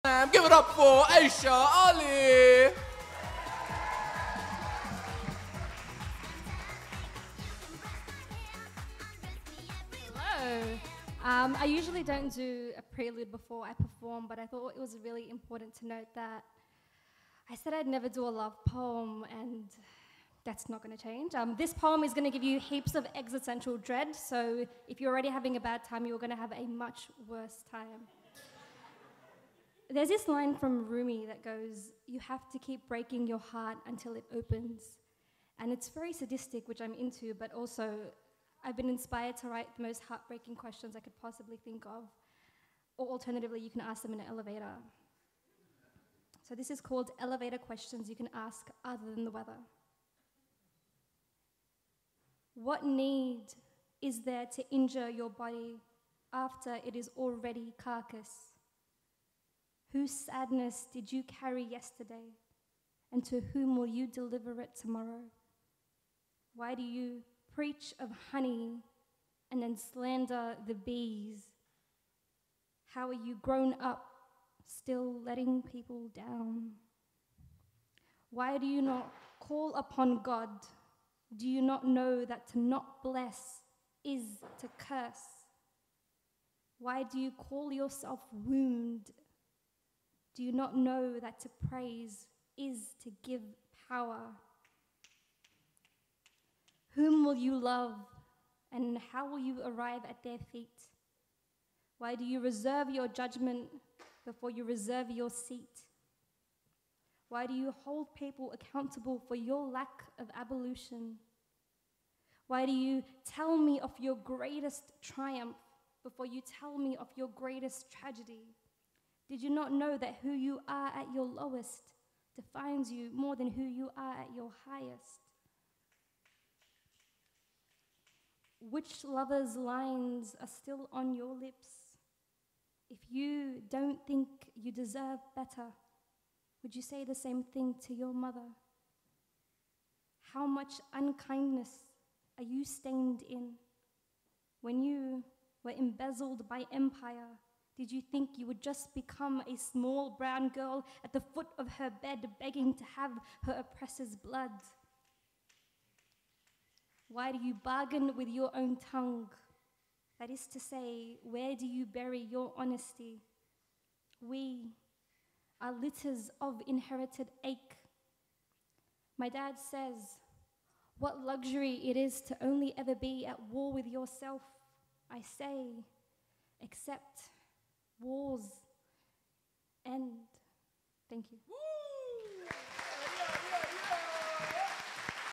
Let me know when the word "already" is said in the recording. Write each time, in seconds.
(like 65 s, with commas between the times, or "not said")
25 s, 57 s.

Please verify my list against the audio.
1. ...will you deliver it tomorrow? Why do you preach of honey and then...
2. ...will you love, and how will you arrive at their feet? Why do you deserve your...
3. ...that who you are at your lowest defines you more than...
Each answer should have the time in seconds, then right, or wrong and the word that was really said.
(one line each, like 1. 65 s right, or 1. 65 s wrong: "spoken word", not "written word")
1. 63 s right
2. 97 s wrong: "reserve", not "deserve"
3. 119 s right.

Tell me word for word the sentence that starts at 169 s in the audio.
My dad says, What luxury it is to only ever be at war with yourself.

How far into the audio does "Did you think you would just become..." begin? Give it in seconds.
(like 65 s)
147 s.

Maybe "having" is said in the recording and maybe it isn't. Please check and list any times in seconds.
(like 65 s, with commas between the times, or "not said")
25 s.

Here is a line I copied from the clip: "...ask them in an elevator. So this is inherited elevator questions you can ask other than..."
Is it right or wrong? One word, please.
wrong.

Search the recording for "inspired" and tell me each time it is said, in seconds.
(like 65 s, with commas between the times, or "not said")
38 s.